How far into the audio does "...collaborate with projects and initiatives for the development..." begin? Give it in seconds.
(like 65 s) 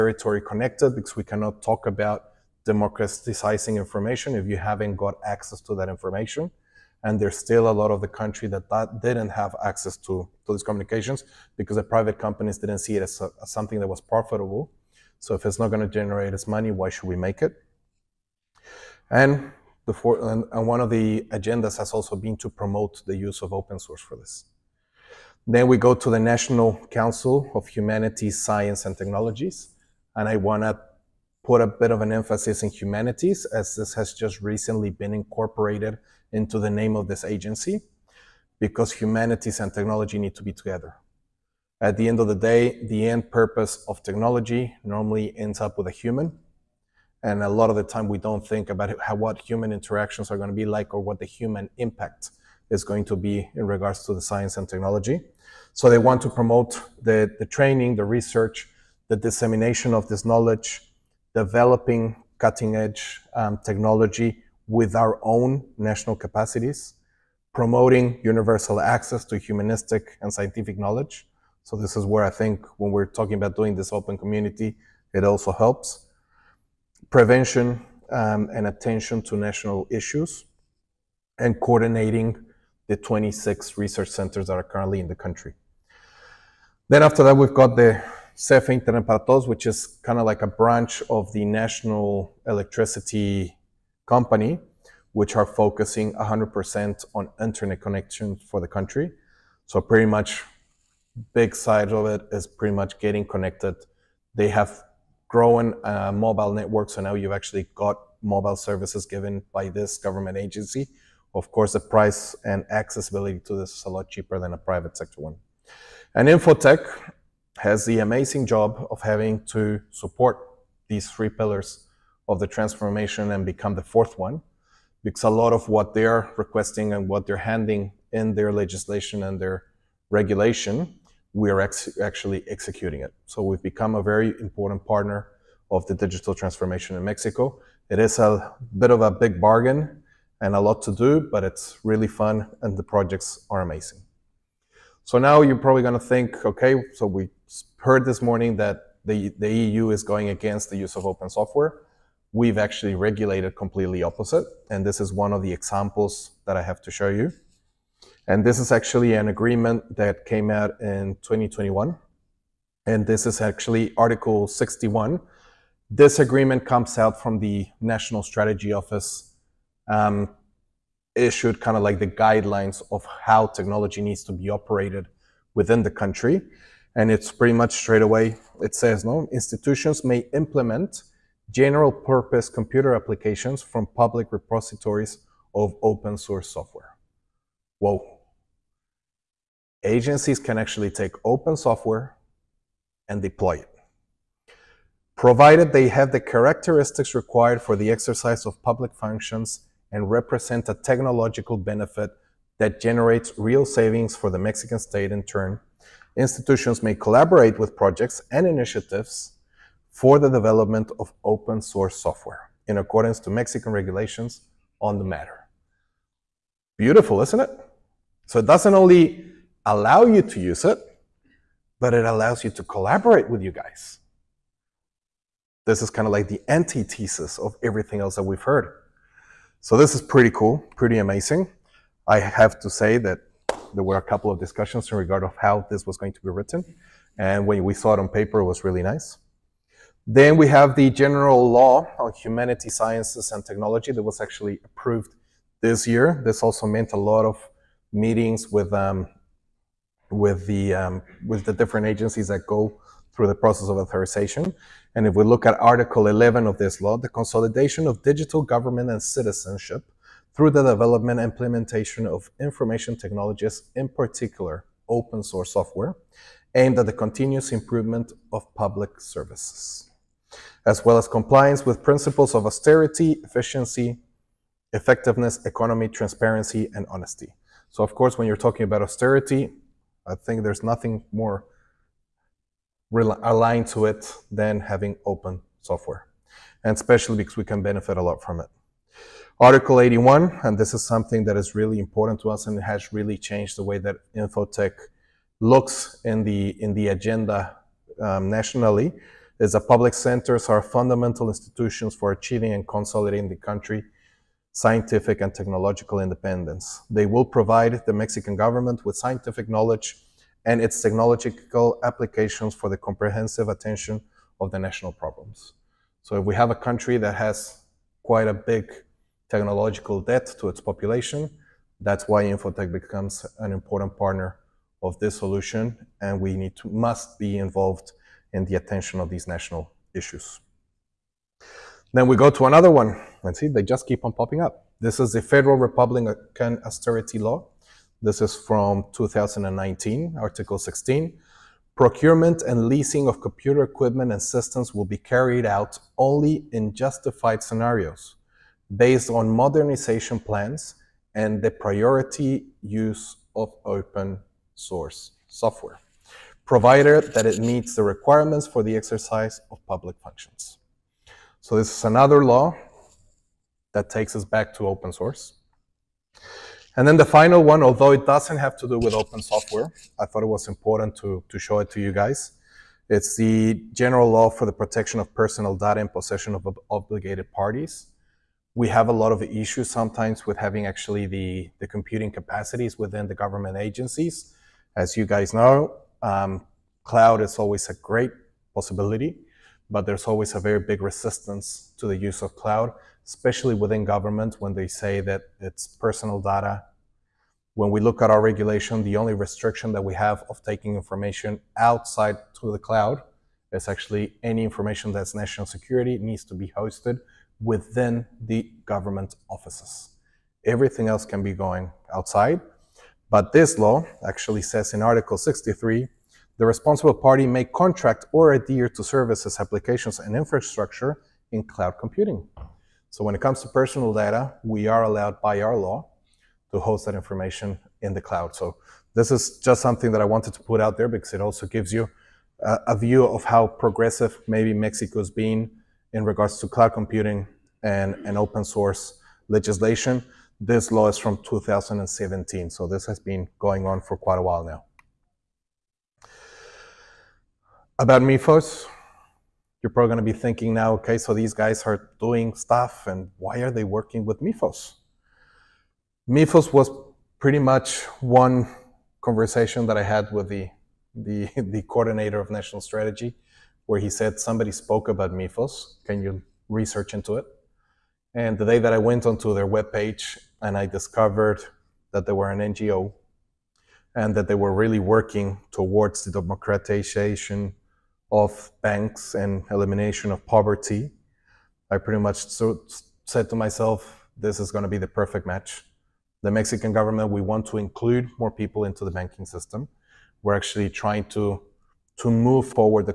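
206 s.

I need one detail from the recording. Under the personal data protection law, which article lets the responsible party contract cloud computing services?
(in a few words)
Article 63.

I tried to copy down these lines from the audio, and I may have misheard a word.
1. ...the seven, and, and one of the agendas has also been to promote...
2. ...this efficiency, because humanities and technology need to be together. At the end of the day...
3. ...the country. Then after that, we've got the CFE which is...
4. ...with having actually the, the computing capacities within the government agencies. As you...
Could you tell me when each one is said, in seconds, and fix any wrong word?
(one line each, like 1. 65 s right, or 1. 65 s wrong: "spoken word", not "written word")
1. 19 s wrong: "four", not "seven"
2. 37 s wrong: "agency", not "efficiency"
3. 85 s right
4. 380 s right.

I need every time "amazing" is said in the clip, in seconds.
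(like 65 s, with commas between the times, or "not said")
117 s, 143 s, 230 s.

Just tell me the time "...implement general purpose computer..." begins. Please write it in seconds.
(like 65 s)
180 s.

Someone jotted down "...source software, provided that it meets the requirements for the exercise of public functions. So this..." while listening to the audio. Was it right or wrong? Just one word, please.
right.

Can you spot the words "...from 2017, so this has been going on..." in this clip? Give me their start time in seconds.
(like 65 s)
440 s.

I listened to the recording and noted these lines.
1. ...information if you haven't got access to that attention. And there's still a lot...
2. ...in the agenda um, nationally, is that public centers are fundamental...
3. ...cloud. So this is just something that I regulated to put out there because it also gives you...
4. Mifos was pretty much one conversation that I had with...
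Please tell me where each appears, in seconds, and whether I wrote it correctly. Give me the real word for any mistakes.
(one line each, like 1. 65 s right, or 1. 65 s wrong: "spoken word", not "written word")
1. 3 s wrong: "information", not "attention"
2. 296 s right
3. 428 s wrong: "wanted", not "regulated"
4. 456 s right.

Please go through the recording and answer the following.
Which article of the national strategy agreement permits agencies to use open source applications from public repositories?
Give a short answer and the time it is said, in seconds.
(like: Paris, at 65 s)
Article 61, at 163 s.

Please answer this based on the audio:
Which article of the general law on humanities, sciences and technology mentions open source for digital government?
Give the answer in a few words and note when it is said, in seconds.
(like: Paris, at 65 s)
Article 11, at 255 s.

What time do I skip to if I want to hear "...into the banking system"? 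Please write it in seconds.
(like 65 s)
488 s.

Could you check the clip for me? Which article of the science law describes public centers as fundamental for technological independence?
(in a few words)
Article 81.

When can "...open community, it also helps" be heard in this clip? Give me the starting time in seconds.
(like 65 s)
73 s.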